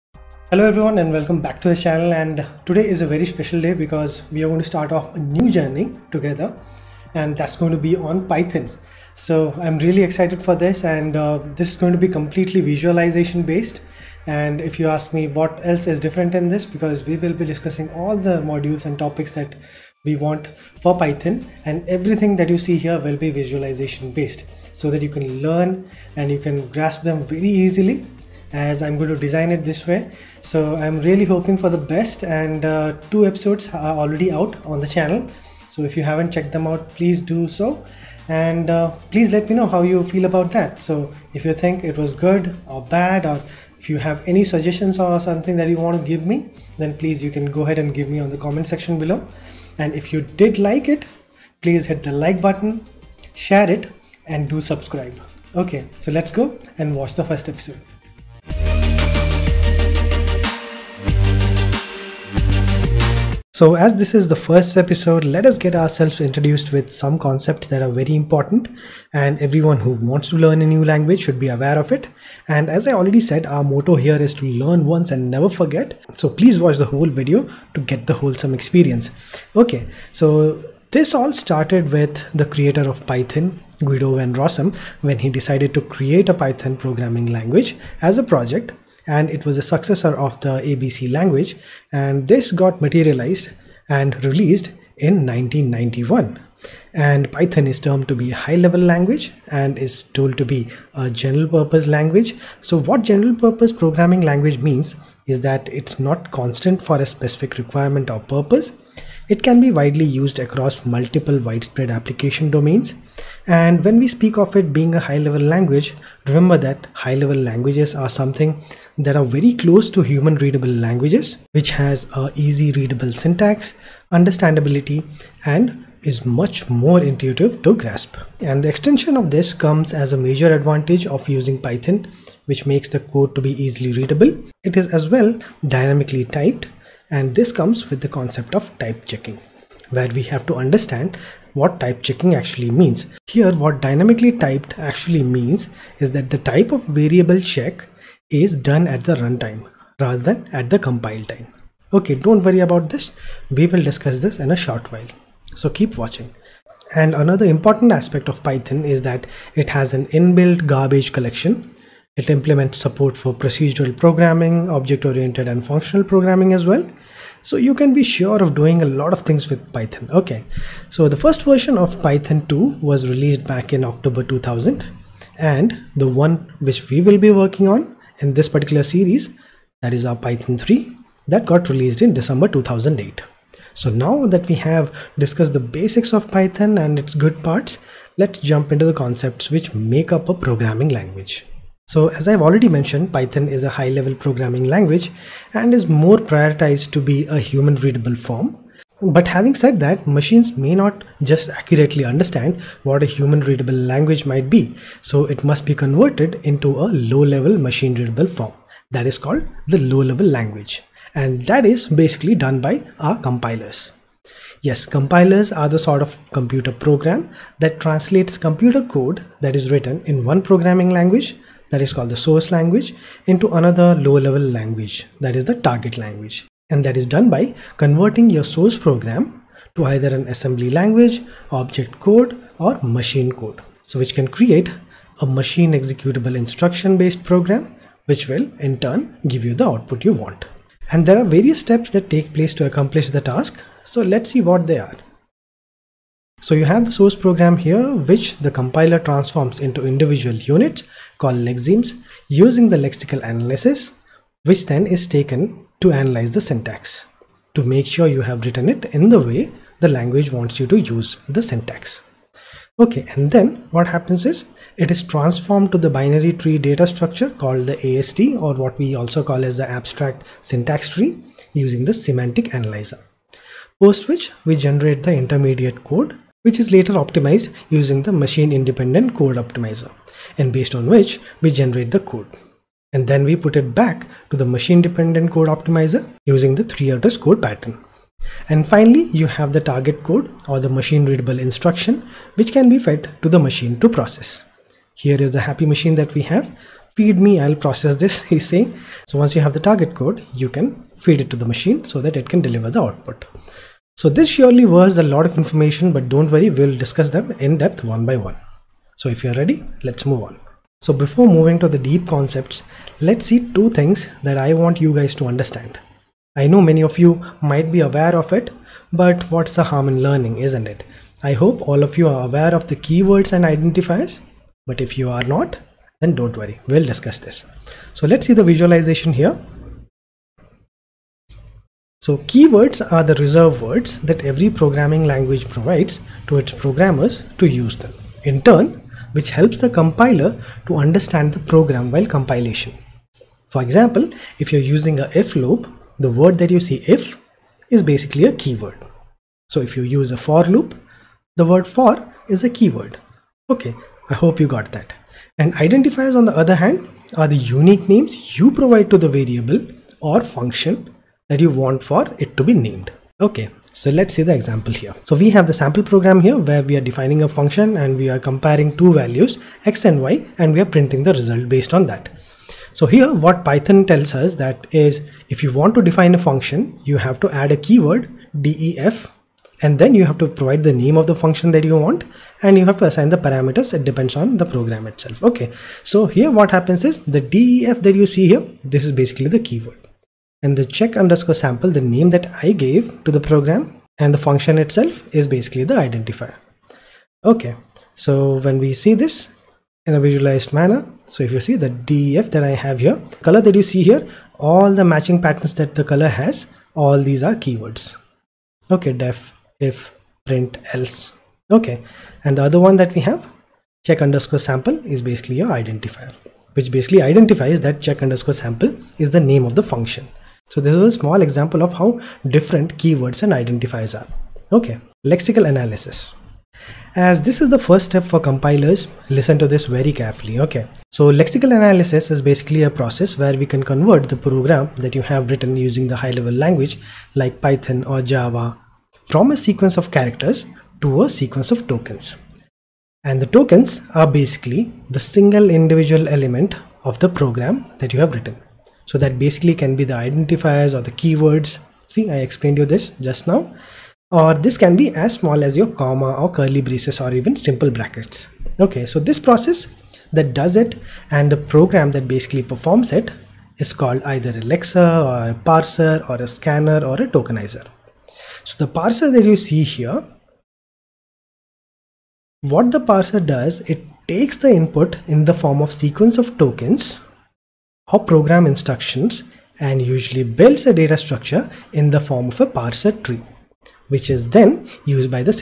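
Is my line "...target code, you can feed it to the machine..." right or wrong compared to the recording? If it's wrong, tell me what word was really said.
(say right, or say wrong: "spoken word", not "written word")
right.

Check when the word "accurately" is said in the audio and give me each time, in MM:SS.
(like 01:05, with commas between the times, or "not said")
03:21.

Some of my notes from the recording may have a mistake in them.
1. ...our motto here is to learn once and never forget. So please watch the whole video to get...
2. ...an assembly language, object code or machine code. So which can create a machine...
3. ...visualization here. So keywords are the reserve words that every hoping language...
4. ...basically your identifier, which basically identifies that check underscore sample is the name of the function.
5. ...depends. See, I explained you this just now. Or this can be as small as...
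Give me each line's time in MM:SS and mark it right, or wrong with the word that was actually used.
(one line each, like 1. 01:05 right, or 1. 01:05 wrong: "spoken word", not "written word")
1. 01:13 right
2. 03:50 right
3. 05:28 wrong: "programming", not "hoping"
4. 06:55 right
5. 07:30 wrong: "keywords", not "depends".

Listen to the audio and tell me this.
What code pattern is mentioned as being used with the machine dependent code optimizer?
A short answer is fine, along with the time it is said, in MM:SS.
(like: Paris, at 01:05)
three address code, at 04:46.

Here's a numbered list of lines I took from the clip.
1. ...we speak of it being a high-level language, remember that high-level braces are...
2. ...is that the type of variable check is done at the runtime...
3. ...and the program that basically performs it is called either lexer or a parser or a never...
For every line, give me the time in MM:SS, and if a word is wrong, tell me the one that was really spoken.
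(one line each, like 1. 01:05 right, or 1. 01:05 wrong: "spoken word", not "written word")
1. 01:53 wrong: "languages", not "braces"
2. 02:25 right
3. 07:41 wrong: "scanner", not "never".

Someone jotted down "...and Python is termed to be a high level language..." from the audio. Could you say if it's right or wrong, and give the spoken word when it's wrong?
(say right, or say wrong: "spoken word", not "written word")
right.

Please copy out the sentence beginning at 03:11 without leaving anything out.
So as I've already mentioned, Python is a high-level programming language and is more prioritized to be a human-readable form.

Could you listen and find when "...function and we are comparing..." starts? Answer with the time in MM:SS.
06:07.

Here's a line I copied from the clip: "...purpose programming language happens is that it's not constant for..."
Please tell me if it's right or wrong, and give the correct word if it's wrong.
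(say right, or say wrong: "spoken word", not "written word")
wrong: "means", not "happens".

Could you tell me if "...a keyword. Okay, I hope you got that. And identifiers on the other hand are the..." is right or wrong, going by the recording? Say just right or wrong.
right.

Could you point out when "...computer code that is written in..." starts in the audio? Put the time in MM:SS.
03:38.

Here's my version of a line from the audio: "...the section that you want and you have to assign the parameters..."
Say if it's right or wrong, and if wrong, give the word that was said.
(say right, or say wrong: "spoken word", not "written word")
wrong: "function", not "section".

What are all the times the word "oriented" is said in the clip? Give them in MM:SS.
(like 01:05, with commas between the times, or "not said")
02:44.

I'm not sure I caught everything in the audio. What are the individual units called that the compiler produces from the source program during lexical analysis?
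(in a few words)
lexemes.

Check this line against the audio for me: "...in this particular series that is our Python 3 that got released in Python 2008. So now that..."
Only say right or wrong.
wrong.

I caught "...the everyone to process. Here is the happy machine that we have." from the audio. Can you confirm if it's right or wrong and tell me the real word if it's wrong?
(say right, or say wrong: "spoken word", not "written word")
wrong: "machine", not "everyone".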